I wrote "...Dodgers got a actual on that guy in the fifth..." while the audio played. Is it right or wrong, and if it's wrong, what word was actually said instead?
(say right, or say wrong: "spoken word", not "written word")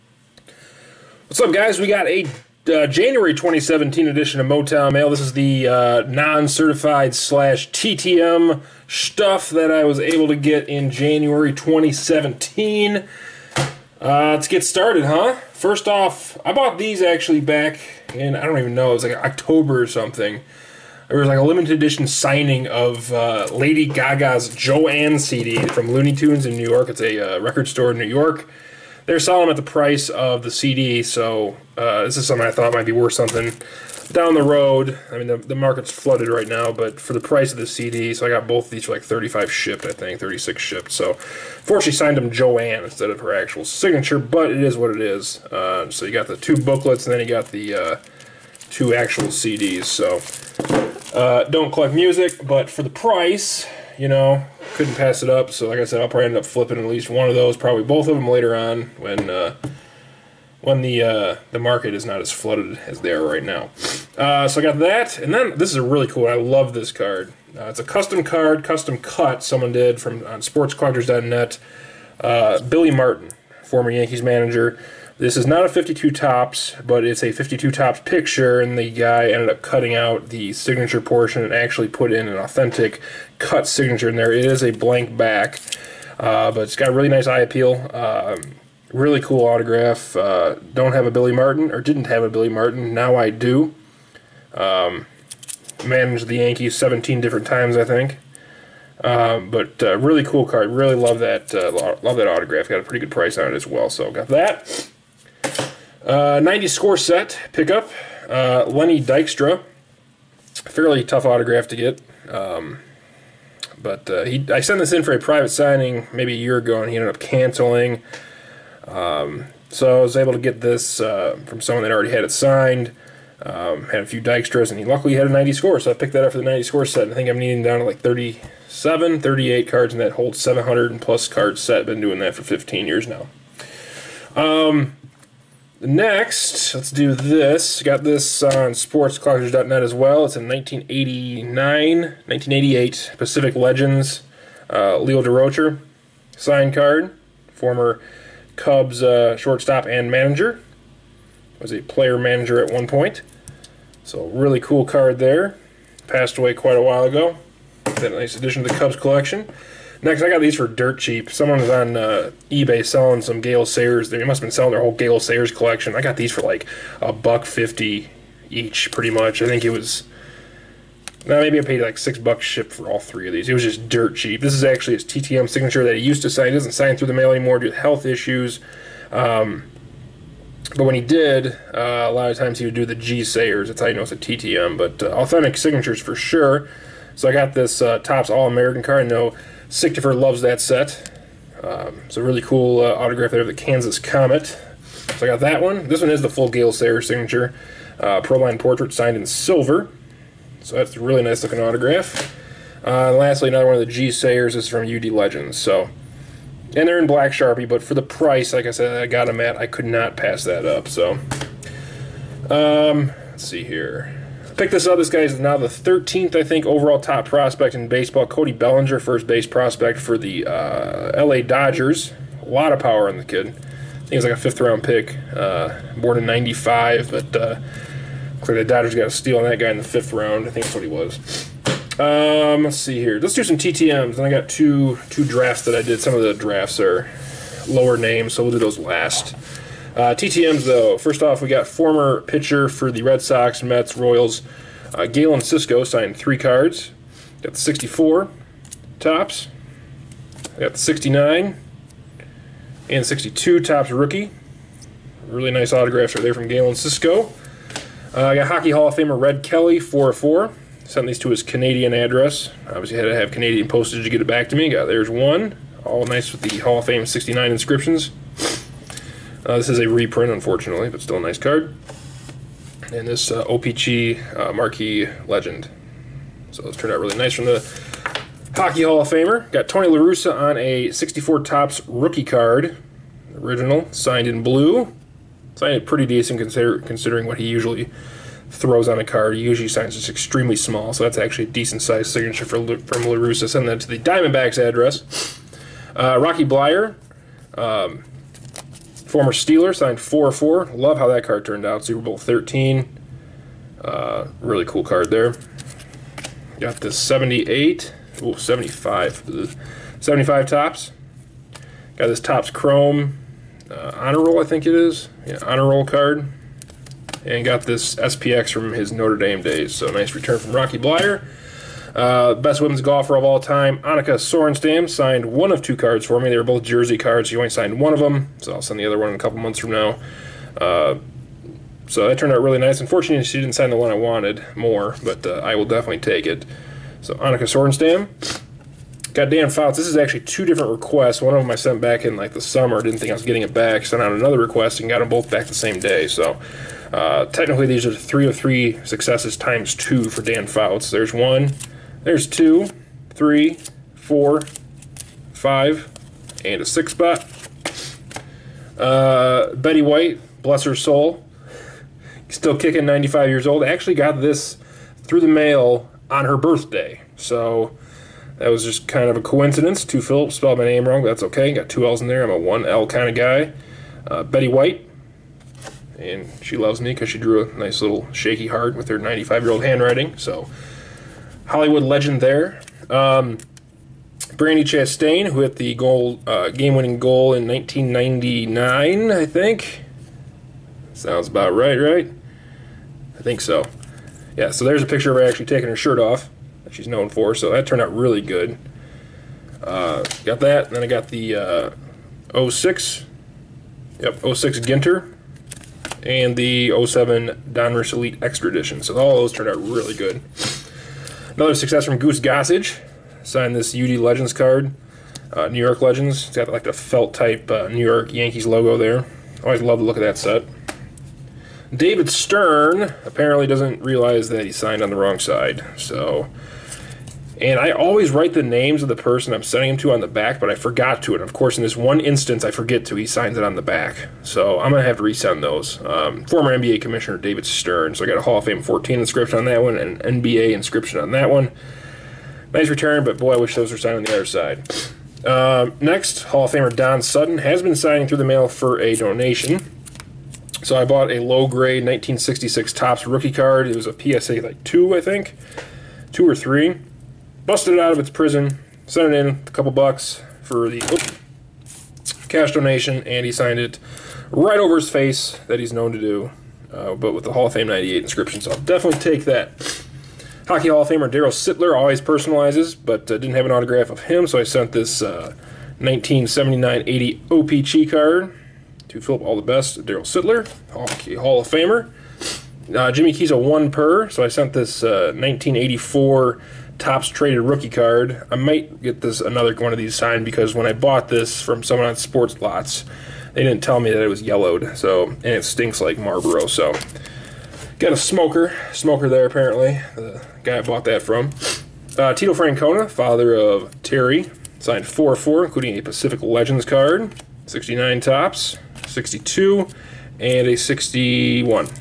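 wrong: "steal", not "actual".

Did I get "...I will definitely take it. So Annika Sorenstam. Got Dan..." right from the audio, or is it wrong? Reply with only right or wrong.
right.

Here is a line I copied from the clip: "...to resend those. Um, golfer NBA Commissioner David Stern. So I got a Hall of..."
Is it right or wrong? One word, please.
wrong.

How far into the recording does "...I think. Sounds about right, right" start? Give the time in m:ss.
6:29.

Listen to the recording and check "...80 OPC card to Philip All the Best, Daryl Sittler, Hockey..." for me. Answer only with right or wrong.
right.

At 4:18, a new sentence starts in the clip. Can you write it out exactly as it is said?
Uh, I got Hockey Hall of Famer Red Kelly, 404.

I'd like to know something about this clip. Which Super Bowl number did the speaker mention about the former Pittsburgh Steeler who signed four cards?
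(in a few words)
13.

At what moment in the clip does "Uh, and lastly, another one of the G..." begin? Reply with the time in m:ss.
3:22.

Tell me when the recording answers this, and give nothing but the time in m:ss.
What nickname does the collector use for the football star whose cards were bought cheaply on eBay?
3:13.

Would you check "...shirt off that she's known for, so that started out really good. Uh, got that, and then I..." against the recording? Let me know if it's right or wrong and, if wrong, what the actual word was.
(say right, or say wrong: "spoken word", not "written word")
wrong: "turned", not "started".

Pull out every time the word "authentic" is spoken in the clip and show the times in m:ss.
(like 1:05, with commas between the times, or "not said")
1:22, 3:05.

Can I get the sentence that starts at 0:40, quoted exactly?
So, fortunately, signed them Joanne instead of her actual signature, but it is what it is.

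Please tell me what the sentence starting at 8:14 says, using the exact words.
So and it stinks like Marlboro.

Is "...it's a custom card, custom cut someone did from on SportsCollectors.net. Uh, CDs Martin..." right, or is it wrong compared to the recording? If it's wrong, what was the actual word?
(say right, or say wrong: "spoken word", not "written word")
wrong: "Billy", not "CDs".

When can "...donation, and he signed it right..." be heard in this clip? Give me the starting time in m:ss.
7:42.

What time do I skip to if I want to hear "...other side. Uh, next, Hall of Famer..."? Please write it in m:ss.
7:24.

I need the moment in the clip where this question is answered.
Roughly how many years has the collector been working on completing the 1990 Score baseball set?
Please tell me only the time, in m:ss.
2:12.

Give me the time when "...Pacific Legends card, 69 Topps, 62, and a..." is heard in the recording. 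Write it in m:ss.
8:25.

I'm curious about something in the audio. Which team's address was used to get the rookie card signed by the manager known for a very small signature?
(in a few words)
Diamondbacks.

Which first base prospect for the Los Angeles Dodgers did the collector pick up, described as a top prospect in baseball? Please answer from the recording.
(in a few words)
Cody Bellinger.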